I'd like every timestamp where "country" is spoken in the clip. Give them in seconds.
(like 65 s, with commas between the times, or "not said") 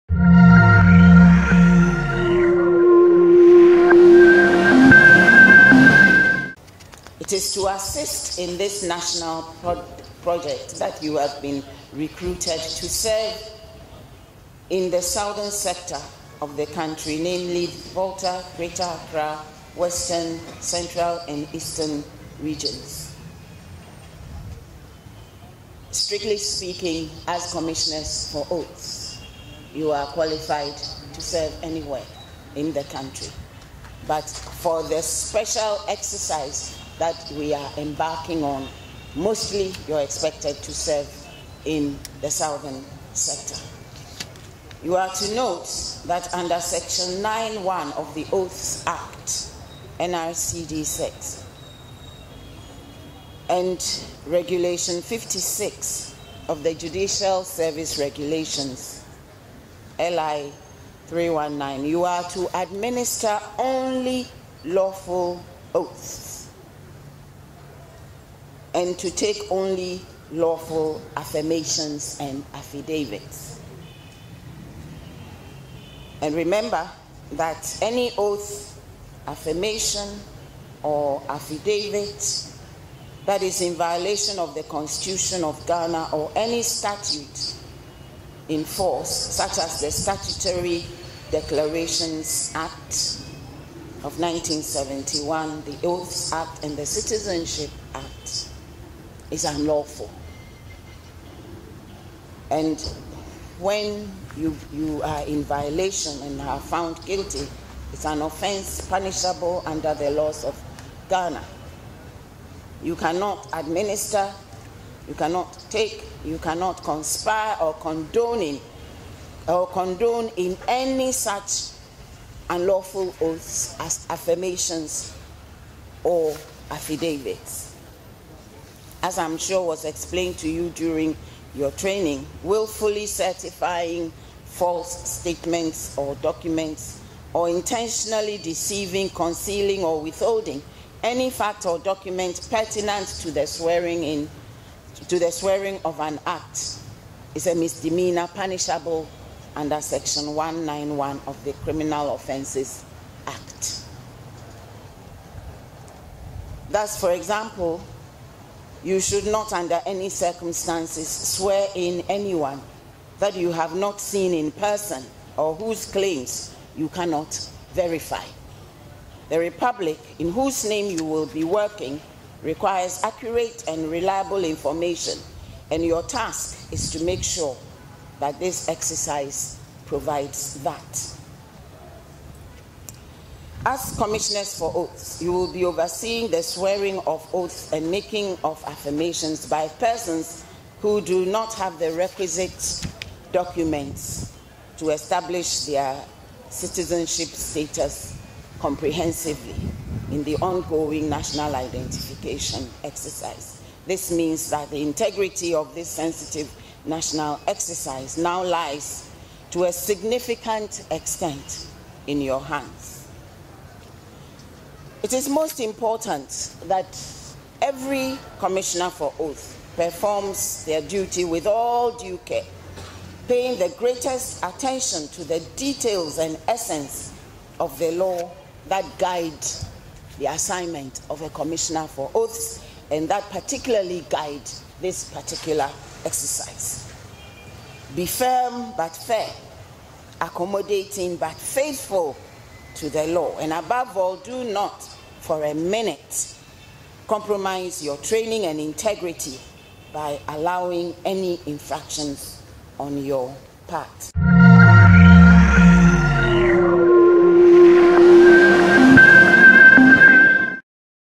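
16 s, 32 s.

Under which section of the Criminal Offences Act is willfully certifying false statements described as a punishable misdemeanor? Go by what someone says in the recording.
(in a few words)
Section 191.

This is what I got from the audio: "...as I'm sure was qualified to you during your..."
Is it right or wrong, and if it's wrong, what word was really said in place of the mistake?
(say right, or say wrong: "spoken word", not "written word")
wrong: "explained", not "qualified".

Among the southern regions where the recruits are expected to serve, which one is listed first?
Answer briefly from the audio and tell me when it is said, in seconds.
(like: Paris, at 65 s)
Volta, at 17 s.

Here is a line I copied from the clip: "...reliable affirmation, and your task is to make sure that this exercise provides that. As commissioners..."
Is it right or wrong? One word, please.
wrong.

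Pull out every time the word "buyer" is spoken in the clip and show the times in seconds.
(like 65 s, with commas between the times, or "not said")
not said.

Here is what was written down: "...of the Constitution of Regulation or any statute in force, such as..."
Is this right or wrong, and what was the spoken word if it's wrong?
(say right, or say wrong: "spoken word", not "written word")
wrong: "Ghana", not "Regulation".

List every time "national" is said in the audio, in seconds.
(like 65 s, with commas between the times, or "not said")
8 s, 201 s, 206 s.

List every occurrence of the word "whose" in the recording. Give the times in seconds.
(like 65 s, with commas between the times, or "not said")
165 s, 170 s.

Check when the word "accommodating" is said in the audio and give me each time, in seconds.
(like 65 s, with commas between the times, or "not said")
240 s.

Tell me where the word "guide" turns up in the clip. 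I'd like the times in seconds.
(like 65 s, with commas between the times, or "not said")
228 s, 234 s.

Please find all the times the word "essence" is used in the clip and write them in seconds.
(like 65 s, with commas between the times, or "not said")
226 s.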